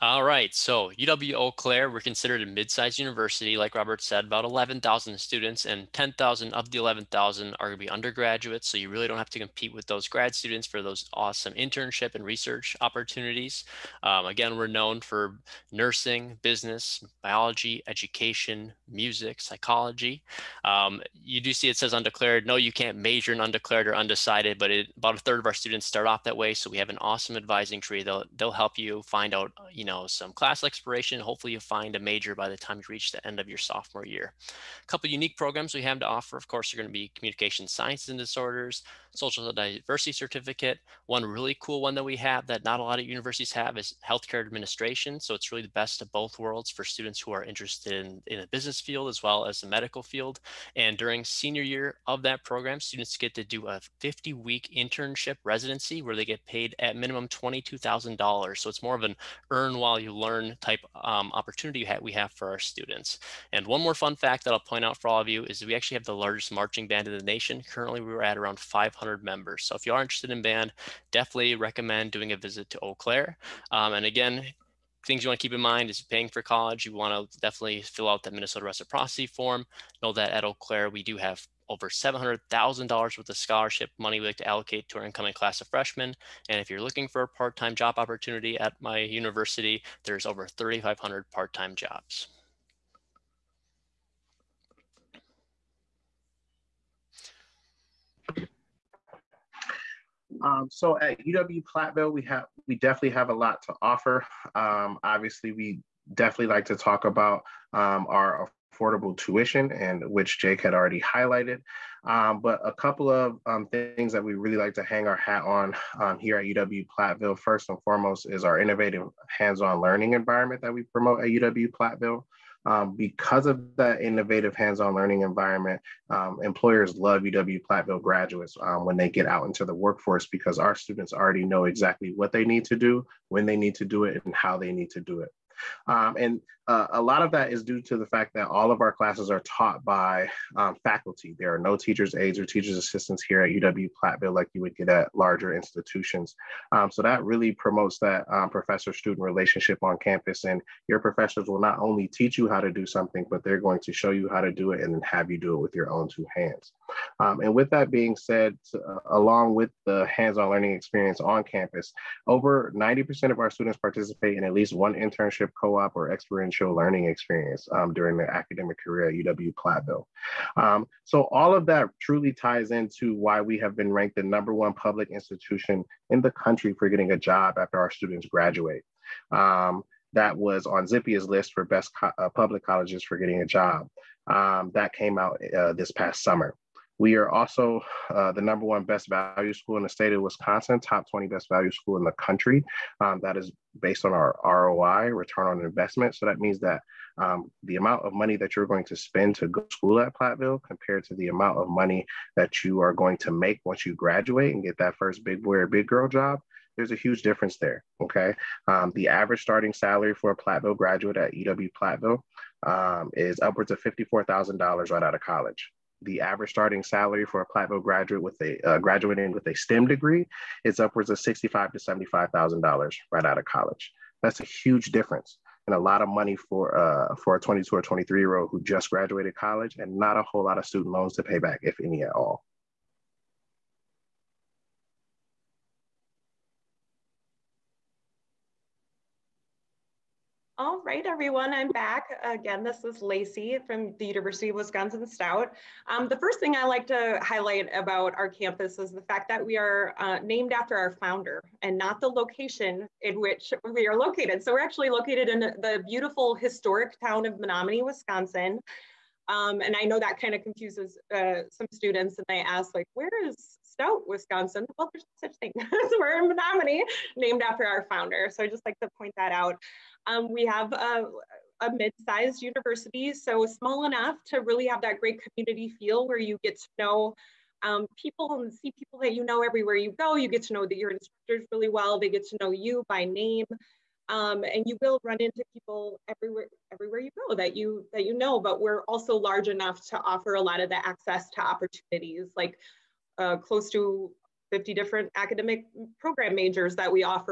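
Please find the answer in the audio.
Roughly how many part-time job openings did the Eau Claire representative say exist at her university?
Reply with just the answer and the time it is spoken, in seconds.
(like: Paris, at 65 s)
3,500, at 90 s.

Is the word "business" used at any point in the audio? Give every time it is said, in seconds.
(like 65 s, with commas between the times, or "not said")
16 s, 48 s.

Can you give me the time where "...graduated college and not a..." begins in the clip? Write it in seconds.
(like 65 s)
228 s.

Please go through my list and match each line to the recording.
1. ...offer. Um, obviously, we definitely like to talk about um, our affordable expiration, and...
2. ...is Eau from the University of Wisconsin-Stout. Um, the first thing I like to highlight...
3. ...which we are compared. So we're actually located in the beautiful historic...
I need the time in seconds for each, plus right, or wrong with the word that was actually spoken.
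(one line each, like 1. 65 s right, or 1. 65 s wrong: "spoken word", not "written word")
1. 103 s wrong: "tuition", not "expiration"
2. 242 s wrong: "Lacey", not "Eau"
3. 253 s wrong: "located", not "compared".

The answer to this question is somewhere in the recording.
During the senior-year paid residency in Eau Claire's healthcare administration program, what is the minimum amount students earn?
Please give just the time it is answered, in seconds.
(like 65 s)
57 s.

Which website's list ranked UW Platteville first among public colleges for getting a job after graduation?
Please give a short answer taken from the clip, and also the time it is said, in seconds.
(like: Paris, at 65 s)
Zippia, at 180 s.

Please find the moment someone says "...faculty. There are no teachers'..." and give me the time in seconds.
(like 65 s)
140 s.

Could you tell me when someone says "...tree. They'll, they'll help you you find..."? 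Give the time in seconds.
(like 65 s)
27 s.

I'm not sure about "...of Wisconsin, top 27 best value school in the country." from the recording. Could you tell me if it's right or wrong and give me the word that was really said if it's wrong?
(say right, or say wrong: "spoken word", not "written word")
wrong: "20", not "27".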